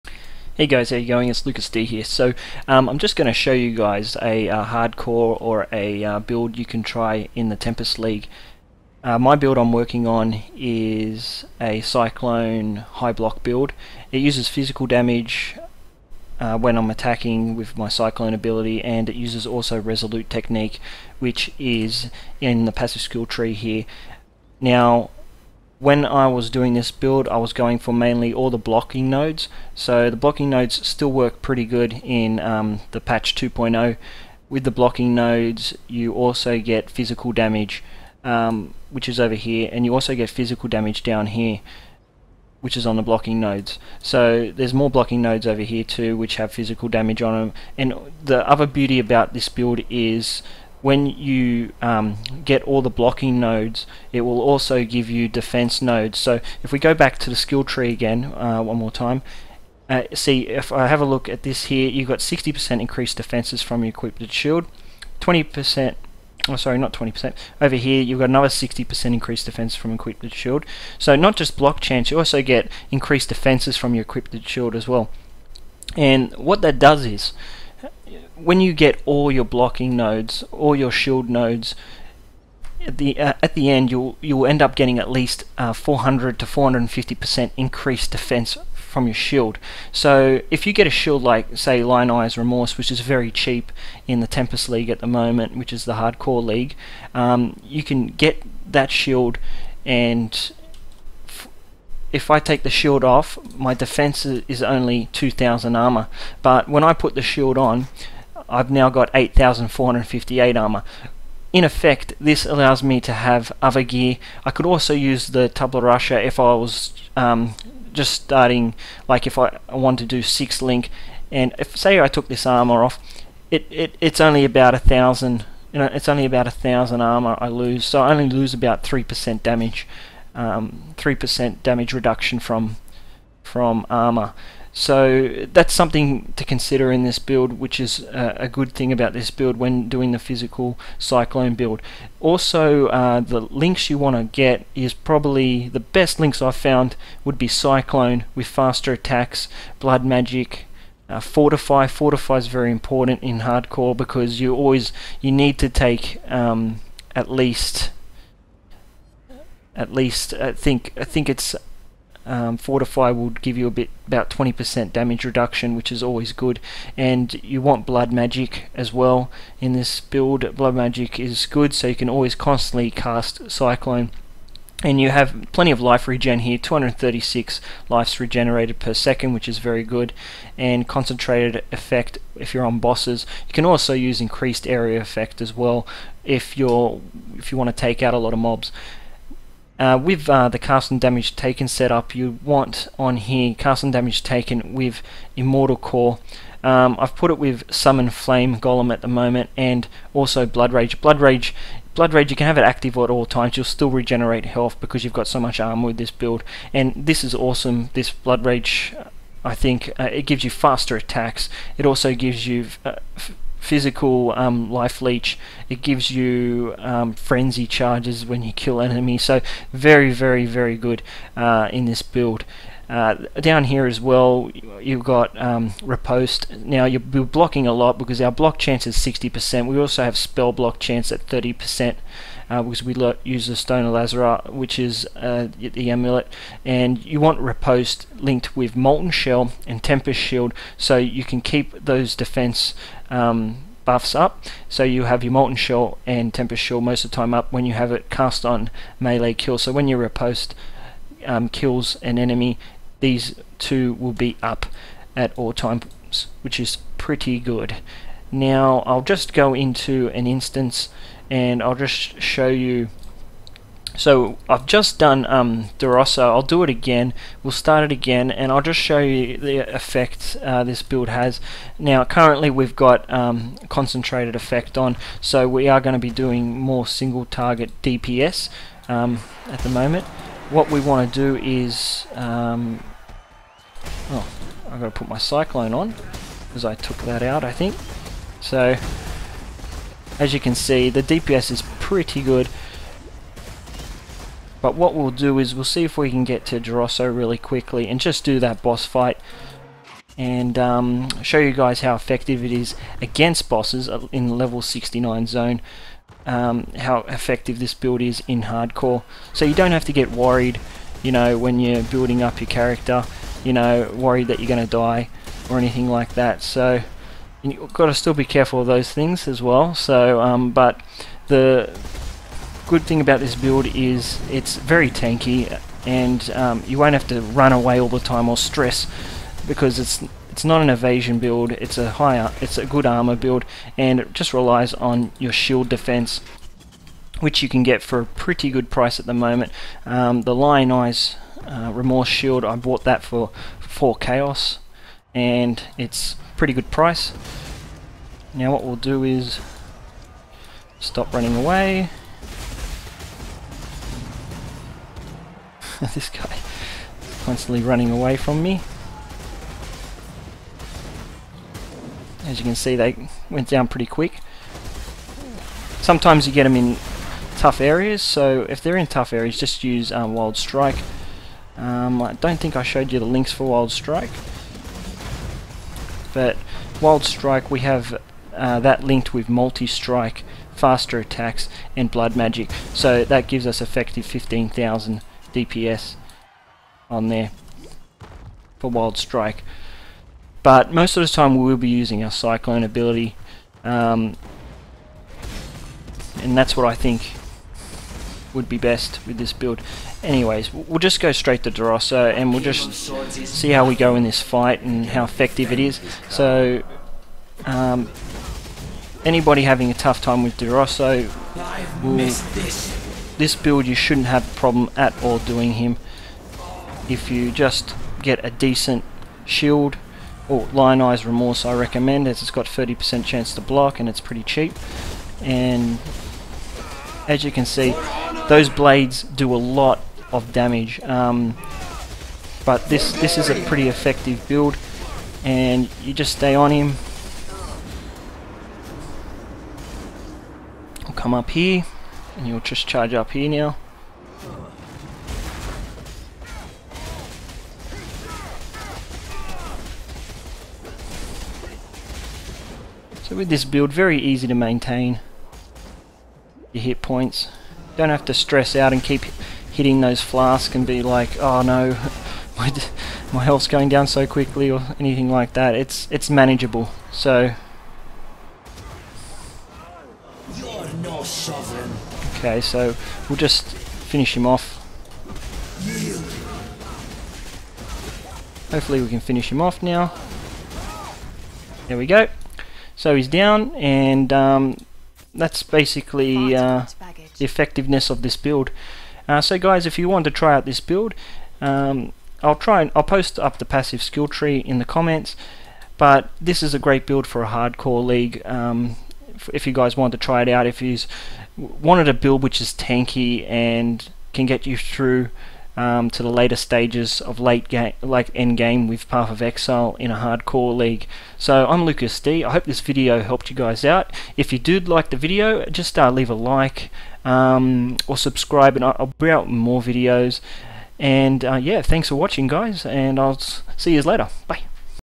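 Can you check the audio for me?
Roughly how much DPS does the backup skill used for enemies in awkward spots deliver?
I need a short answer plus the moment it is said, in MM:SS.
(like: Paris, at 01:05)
15,000, at 06:24.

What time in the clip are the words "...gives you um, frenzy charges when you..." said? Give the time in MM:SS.
03:35.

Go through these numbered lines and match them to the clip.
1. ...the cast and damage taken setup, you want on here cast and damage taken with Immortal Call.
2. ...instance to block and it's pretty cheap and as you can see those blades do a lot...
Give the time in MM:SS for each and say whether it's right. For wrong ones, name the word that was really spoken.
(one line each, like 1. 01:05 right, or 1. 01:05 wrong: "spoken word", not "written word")
1. 03:10 right
2. 07:03 wrong: "chance", not "instance".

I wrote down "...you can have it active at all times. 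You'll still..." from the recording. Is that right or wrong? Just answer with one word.
right.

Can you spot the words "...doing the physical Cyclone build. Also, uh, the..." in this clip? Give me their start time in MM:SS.
02:19.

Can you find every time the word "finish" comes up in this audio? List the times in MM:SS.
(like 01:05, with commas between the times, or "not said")
07:53, 07:59.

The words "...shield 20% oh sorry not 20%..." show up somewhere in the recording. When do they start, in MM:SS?
01:04.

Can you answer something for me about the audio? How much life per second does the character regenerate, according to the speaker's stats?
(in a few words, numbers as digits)
236.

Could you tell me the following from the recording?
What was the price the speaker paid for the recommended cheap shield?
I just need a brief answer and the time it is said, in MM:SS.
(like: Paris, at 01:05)
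4 Chaos, at 05:43.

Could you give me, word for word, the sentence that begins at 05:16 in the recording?
So you've got to still be careful of those things as well.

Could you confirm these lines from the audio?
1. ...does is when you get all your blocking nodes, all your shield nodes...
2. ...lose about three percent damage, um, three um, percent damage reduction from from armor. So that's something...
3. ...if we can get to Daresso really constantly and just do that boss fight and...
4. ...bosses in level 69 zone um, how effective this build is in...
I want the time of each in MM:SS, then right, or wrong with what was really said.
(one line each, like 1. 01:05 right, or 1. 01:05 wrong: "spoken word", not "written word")
1. 01:16 right
2. 02:08 right
3. 04:55 wrong: "quickly", not "constantly"
4. 05:03 right.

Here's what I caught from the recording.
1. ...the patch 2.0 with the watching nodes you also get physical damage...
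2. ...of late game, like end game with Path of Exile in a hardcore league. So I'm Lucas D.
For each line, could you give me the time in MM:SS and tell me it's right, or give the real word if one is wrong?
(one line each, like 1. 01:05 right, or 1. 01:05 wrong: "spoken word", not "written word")
1. 00:32 wrong: "blocking", not "watching"
2. 08:27 right.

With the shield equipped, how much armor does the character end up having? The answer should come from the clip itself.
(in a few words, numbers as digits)
8,458.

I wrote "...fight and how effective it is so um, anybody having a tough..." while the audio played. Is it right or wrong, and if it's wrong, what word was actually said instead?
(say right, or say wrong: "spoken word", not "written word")
right.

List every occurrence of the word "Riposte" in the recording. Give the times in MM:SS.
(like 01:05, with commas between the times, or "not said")
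03:45, 03:57, 04:09.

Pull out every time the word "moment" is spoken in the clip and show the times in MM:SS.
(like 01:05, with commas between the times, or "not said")
01:35, 03:19, 04:39, 05:39.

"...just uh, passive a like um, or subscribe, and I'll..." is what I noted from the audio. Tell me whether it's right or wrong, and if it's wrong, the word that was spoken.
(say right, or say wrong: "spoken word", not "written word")
wrong: "leave", not "passive".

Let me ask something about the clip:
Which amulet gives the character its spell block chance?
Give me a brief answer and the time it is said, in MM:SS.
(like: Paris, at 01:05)
Stone of Lazhwar, at 03:53.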